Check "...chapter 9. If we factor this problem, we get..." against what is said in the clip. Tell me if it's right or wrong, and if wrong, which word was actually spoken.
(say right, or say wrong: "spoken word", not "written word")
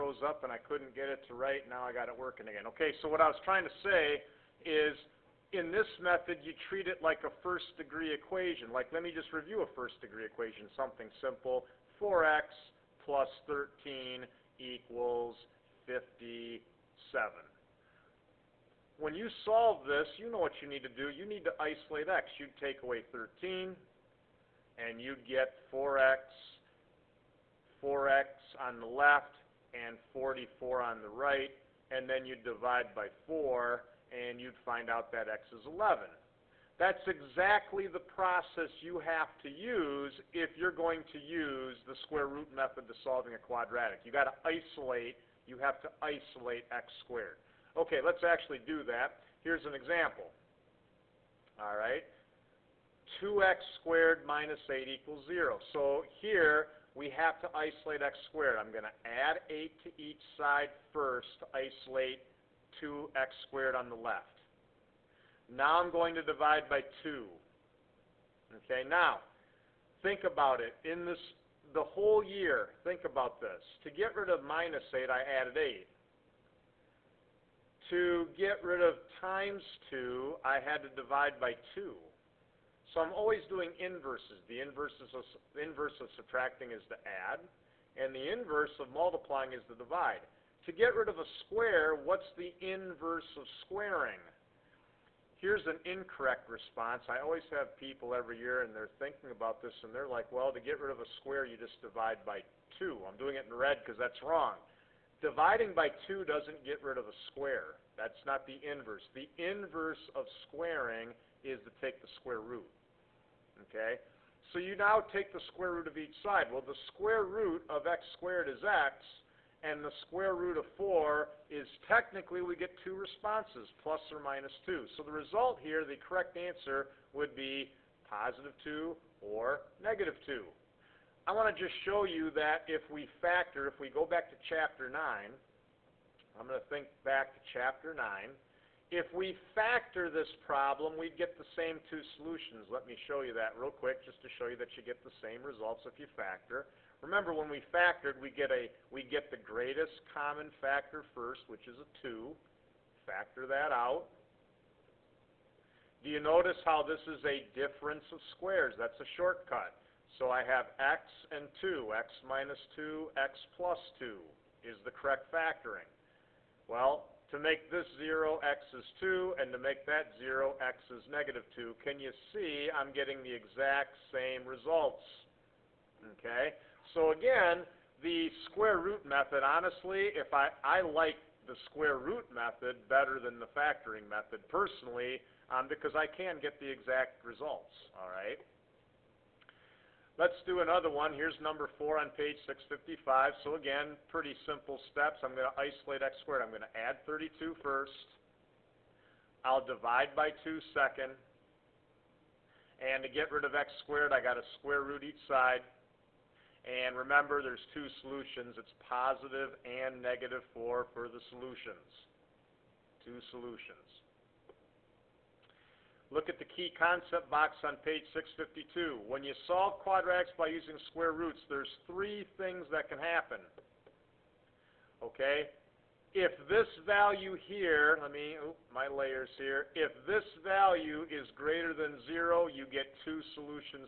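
right.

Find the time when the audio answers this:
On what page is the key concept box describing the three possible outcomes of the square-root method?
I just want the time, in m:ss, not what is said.
3:37.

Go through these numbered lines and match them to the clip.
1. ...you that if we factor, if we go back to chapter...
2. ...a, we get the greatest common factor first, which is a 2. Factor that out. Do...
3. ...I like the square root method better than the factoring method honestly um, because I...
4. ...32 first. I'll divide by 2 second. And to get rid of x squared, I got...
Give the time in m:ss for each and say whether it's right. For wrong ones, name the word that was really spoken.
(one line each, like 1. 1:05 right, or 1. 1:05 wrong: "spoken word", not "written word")
1. 2:12 right
2. 2:28 right
3. 3:00 wrong: "personally", not "honestly"
4. 3:17 right.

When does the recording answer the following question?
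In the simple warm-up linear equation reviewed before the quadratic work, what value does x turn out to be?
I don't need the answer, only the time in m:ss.
0:35.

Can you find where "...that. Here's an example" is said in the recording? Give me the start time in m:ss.
0:48.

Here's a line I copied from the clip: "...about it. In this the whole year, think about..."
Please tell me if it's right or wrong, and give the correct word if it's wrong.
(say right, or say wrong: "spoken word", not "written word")
right.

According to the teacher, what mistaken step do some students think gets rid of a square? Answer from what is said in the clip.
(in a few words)
divide by 2.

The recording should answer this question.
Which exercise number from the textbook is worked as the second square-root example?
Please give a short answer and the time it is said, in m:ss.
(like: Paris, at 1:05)
4, at 3:11.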